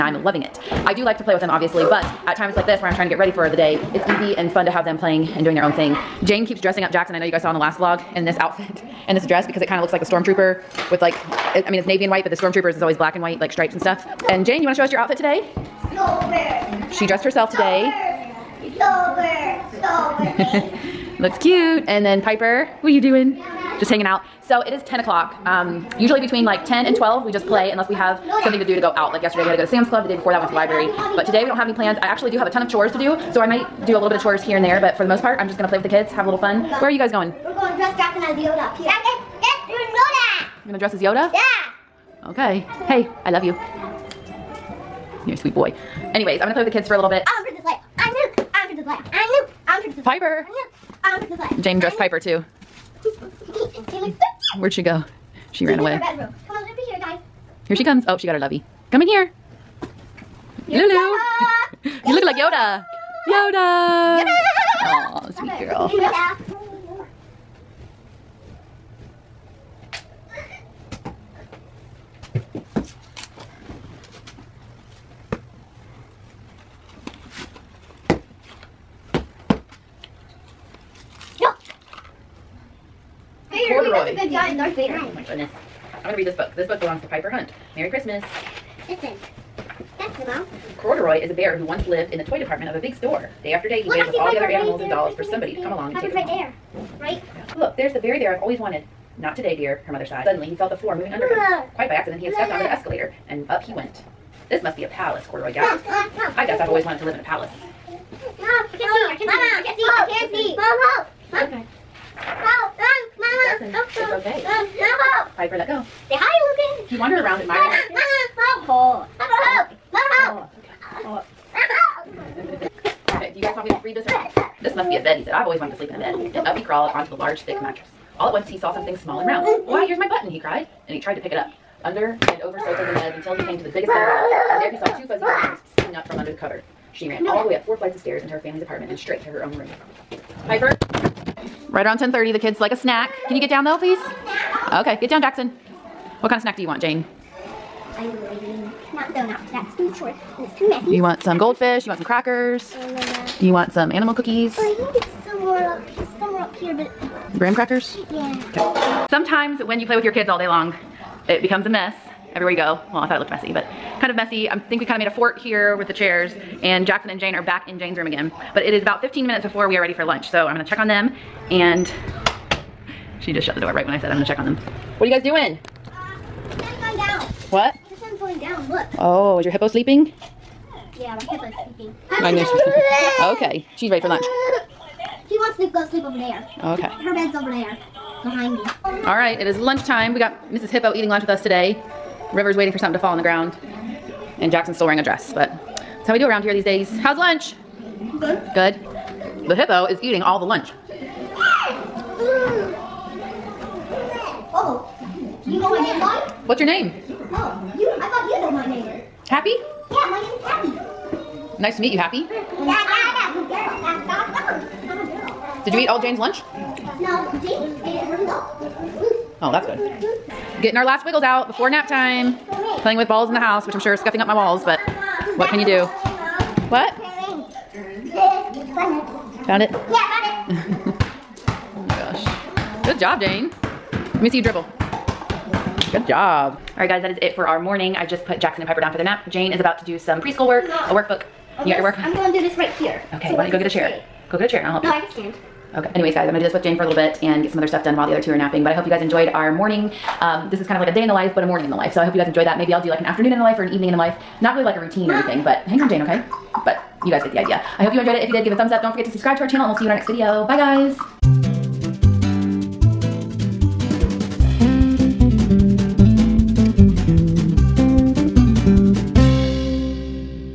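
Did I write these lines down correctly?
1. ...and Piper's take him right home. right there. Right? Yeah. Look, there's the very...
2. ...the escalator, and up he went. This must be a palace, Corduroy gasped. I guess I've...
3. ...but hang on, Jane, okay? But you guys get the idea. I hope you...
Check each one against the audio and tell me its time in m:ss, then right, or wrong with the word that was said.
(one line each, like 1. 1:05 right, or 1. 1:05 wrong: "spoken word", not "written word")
1. 1:35 right
2. 1:42 right
3. 4:15 right.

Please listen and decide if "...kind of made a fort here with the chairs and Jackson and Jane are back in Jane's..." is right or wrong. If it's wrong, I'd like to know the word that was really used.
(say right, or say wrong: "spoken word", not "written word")
right.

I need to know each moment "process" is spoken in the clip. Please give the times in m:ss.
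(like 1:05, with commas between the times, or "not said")
not said.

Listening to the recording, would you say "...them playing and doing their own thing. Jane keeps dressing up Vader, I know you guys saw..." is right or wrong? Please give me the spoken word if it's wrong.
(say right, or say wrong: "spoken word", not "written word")
wrong: "Jackson", not "Vader".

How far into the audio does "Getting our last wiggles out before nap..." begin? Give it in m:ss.
3:40.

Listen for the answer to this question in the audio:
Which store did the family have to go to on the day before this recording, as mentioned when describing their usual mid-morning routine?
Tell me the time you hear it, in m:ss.
0:29.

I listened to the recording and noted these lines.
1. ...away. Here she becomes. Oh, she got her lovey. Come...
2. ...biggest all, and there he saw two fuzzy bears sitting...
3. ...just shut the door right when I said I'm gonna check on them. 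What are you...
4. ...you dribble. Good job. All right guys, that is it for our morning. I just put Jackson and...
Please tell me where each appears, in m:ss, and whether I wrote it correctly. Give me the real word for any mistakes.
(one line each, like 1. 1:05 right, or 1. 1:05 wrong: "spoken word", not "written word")
1. 0:55 wrong: "comes", not "becomes"
2. 2:13 right
3. 2:53 right
4. 3:54 right.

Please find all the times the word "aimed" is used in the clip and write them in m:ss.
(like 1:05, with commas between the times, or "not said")
not said.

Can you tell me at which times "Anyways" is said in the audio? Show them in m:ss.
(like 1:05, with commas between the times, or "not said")
0:46, 4:05.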